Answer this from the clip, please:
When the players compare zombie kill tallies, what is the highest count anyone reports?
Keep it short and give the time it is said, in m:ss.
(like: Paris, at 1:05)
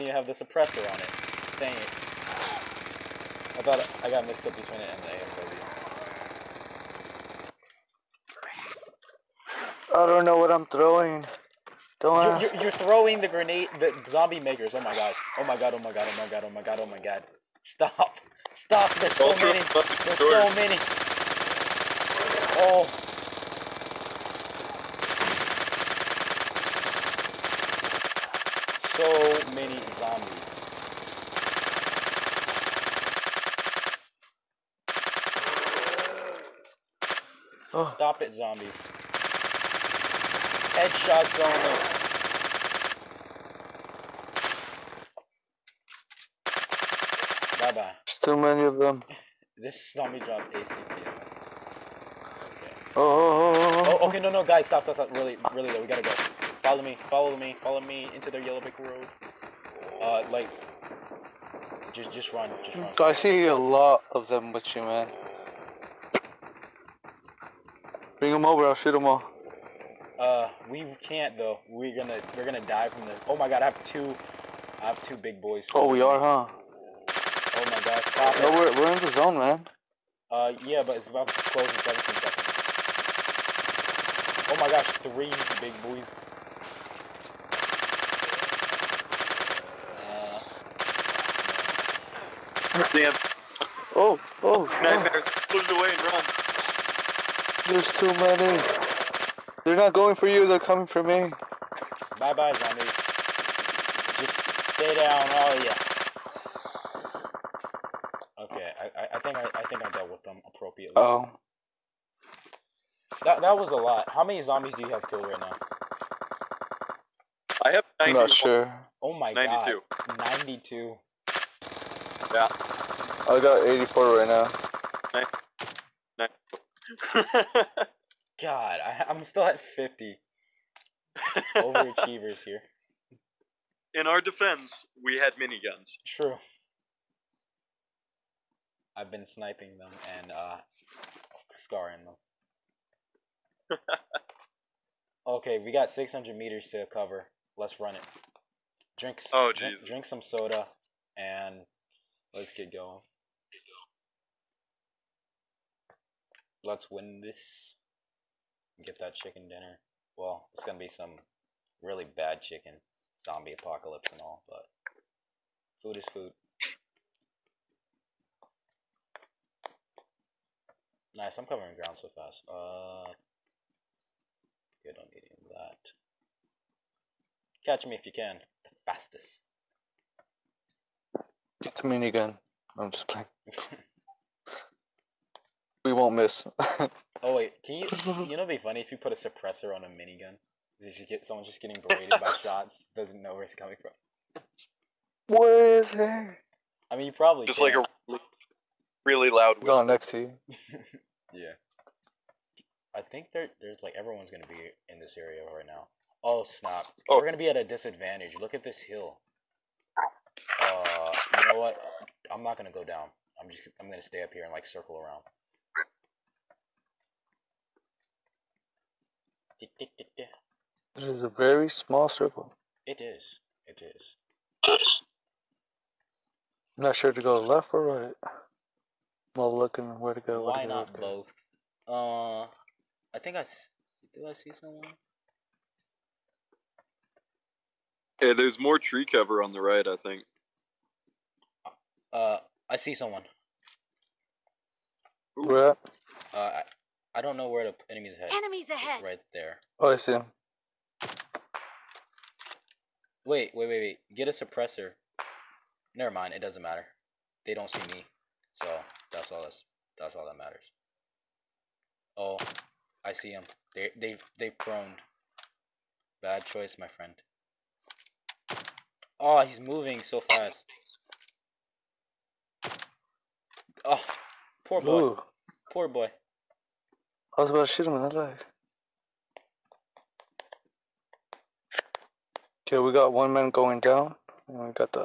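92, at 1:57.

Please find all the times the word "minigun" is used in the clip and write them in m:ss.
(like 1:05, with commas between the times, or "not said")
2:15, 3:01, 3:09.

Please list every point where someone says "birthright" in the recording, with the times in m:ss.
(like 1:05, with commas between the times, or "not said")
not said.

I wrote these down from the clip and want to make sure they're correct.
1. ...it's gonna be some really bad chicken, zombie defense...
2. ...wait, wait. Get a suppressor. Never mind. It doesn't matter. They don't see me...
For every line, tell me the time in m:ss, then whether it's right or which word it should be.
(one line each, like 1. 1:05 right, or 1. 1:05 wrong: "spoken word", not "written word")
1. 2:40 wrong: "apocalypse", not "defense"
2. 4:13 right.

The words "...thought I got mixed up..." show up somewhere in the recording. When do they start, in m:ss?
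0:03.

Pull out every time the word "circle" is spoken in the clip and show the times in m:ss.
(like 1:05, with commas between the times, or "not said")
3:34, 3:42.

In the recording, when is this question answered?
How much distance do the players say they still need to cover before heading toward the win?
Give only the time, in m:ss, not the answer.
2:25.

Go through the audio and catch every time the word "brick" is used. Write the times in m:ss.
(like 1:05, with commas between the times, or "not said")
0:58.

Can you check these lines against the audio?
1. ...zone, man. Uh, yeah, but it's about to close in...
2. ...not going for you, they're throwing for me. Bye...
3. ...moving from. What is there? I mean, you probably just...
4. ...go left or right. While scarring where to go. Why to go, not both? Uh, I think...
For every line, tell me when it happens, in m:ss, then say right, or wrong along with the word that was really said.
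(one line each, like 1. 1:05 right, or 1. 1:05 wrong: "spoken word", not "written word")
1. 1:19 right
2. 1:39 wrong: "coming", not "throwing"
3. 3:13 wrong: "coming", not "moving"
4. 3:47 wrong: "looking", not "scarring".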